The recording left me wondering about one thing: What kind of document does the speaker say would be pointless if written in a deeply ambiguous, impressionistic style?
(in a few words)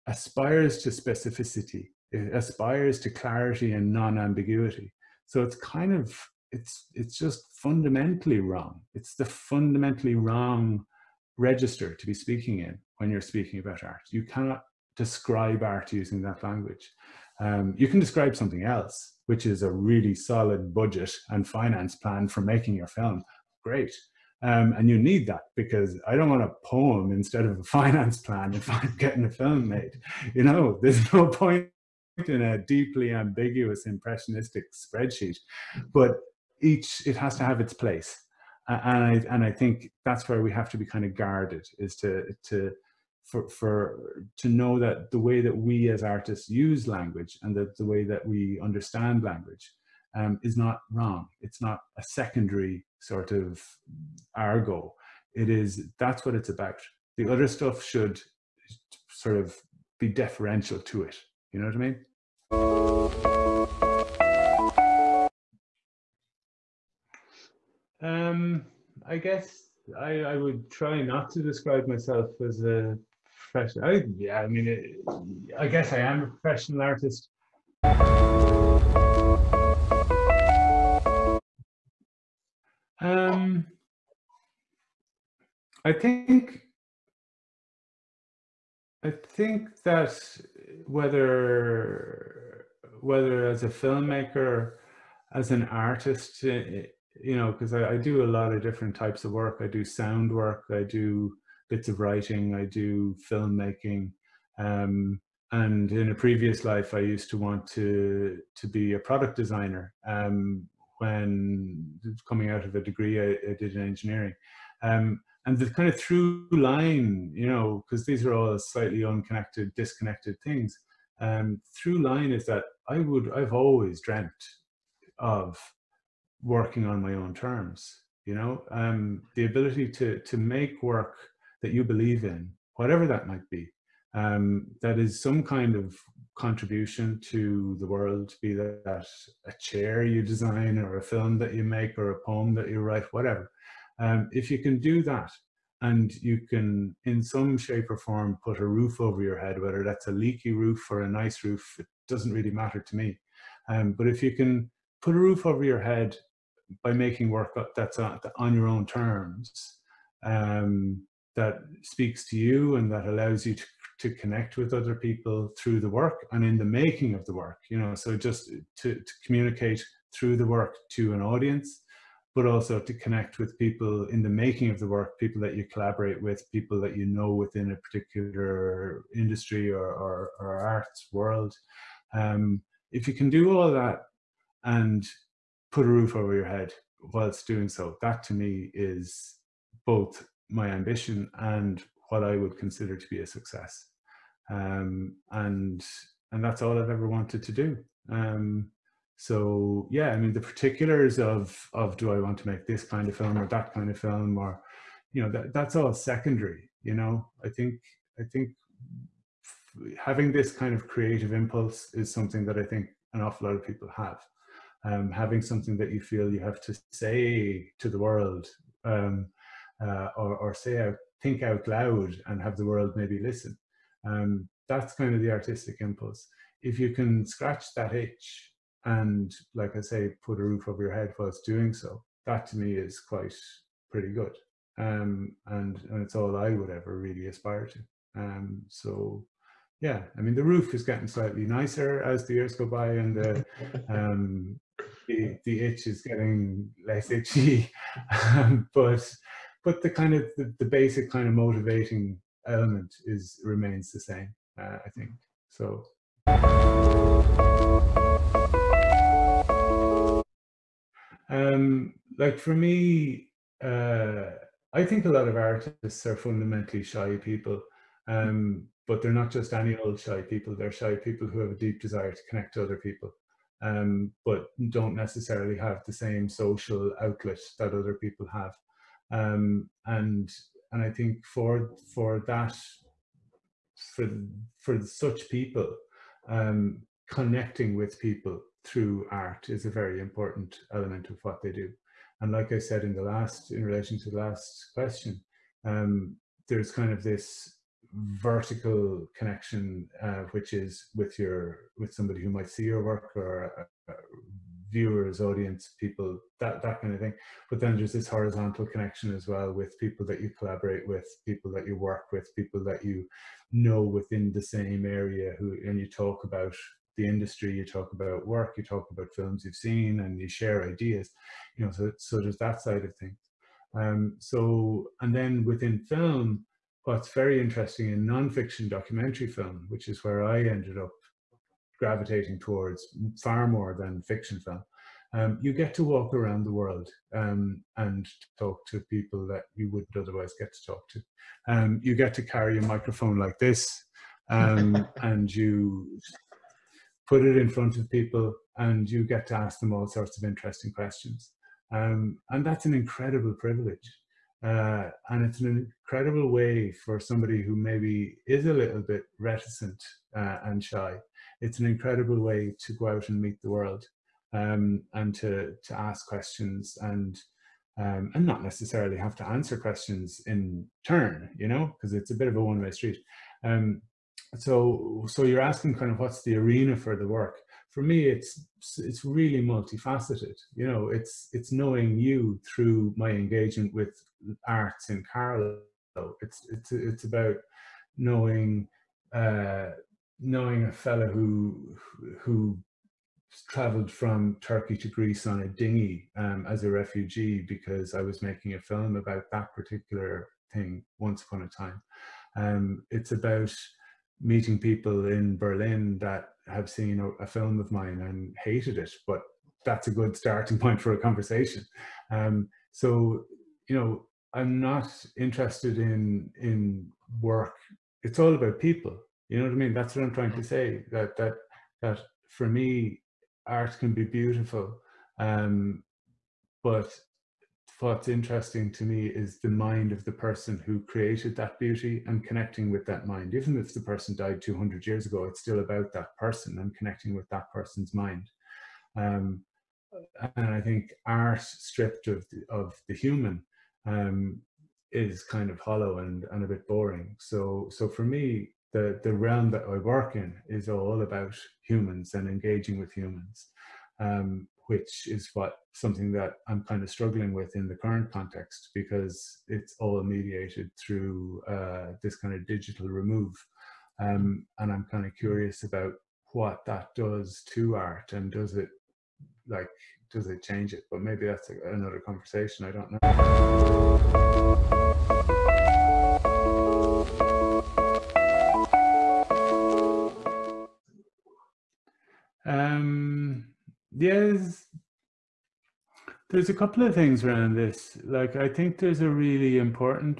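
spreadsheet.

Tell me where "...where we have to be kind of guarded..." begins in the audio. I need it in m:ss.
0:40.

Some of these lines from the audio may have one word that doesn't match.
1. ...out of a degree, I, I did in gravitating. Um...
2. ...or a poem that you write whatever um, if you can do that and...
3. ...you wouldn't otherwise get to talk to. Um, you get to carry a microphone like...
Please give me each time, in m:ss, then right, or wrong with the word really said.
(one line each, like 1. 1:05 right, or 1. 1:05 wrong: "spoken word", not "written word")
1. 1:52 wrong: "engineering", not "gravitating"
2. 2:21 right
3. 5:39 right.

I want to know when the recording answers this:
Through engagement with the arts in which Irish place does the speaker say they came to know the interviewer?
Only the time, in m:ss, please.
6:25.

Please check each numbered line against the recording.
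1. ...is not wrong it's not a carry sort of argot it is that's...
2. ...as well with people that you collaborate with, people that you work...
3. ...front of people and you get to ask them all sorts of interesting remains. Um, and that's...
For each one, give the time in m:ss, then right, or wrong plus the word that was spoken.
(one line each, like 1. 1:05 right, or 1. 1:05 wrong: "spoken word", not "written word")
1. 0:50 wrong: "secondary", not "carry"
2. 5:09 right
3. 5:47 wrong: "questions", not "remains".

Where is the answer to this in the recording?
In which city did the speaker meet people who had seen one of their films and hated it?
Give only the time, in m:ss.
6:45.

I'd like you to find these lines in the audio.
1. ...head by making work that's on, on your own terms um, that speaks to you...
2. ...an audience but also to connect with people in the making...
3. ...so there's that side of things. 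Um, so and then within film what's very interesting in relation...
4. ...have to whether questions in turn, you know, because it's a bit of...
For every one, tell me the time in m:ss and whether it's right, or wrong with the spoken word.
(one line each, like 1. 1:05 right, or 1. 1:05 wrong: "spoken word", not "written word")
1. 2:35 right
2. 2:51 right
3. 5:21 wrong: "nonfiction", not "relation"
4. 6:08 wrong: "answer", not "whether".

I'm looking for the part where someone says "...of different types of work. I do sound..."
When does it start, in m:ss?
1:38.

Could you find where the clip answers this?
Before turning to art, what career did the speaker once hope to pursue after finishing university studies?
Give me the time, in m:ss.
1:48.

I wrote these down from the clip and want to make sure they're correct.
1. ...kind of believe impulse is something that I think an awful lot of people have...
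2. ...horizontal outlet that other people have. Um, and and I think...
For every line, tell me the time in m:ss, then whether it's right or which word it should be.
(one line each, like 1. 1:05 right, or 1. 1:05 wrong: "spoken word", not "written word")
1. 3:30 wrong: "creative", not "believe"
2. 4:36 wrong: "social", not "horizontal".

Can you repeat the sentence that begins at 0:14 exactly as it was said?
You cannot describe art using that language.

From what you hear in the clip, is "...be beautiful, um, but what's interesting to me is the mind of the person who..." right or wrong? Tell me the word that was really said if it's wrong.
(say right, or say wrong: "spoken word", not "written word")
right.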